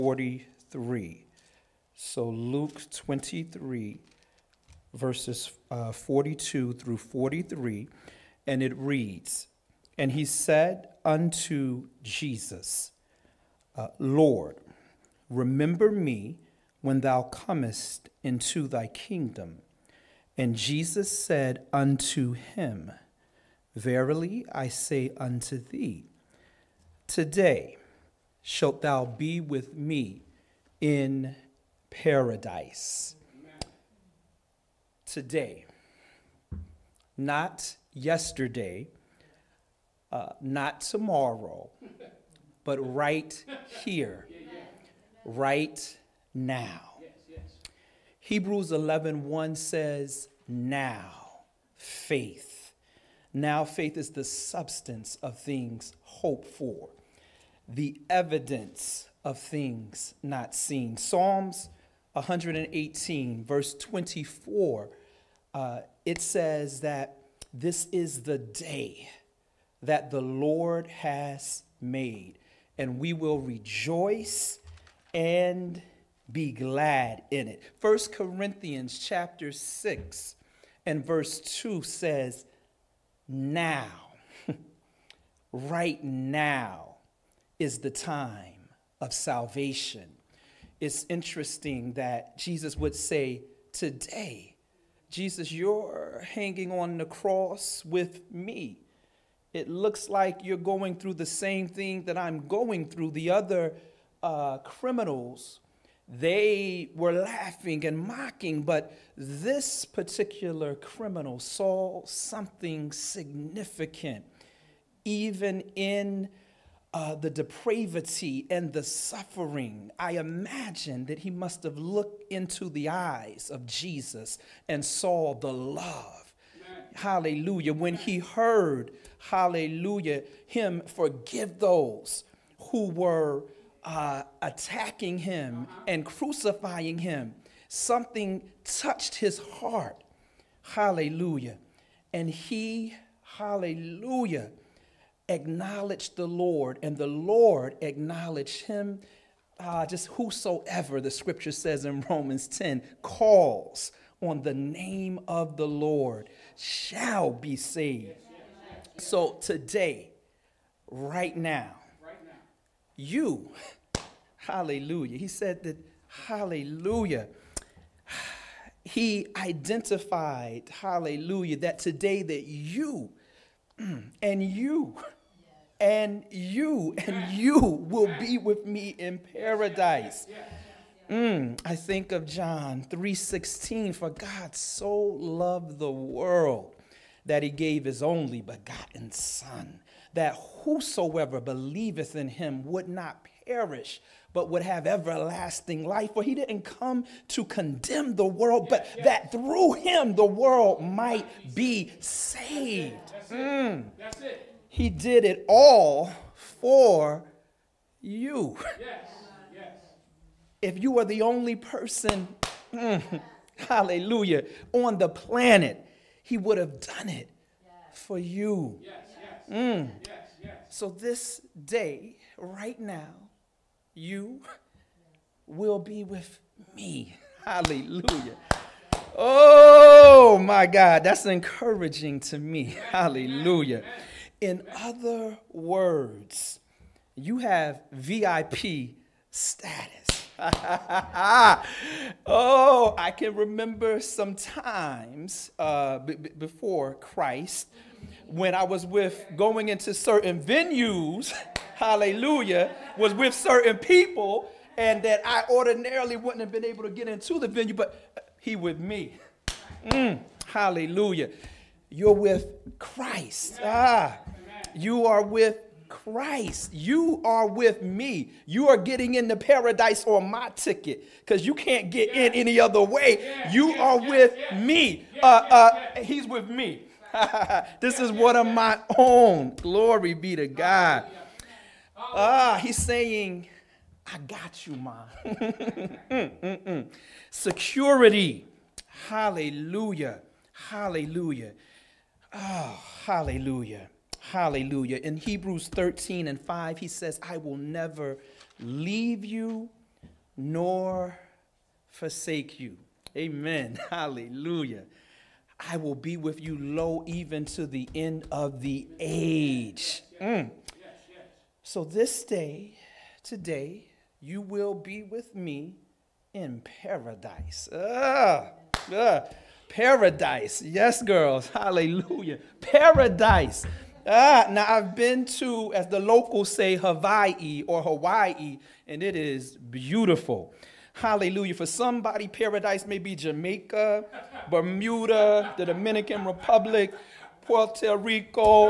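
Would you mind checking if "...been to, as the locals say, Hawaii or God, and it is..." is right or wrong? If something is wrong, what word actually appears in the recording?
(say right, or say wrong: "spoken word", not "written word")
wrong: "Hawaii", not "God".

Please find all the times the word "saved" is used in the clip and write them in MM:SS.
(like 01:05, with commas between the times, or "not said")
02:37, 03:21.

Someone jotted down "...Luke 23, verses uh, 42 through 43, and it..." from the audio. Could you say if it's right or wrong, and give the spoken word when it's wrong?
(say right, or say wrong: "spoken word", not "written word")
right.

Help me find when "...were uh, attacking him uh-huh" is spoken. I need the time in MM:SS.
02:12.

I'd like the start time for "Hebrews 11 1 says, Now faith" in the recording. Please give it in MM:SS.
00:48.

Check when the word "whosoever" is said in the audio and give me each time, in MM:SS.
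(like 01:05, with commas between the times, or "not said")
02:30, 03:10.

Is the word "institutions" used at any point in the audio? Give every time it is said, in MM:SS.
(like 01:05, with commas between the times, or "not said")
not said.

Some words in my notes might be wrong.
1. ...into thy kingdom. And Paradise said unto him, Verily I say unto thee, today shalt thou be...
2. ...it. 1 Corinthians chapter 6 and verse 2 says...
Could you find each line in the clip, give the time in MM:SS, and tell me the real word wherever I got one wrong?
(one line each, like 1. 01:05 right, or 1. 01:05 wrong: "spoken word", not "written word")
1. 00:18 wrong: "Jesus", not "Paradise"
2. 01:17 right.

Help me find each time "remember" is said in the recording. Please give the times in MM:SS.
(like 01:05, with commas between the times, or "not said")
00:15, 04:03.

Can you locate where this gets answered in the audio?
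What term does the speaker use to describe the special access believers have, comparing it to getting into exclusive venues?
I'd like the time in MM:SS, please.
03:57.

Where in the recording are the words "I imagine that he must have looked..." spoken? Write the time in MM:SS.
01:59.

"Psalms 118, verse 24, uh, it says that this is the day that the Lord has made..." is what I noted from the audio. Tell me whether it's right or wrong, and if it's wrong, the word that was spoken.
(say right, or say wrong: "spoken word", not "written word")
right.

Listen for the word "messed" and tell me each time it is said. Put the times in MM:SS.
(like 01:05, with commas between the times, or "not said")
not said.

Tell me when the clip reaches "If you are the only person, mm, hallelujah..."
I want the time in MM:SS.
03:30.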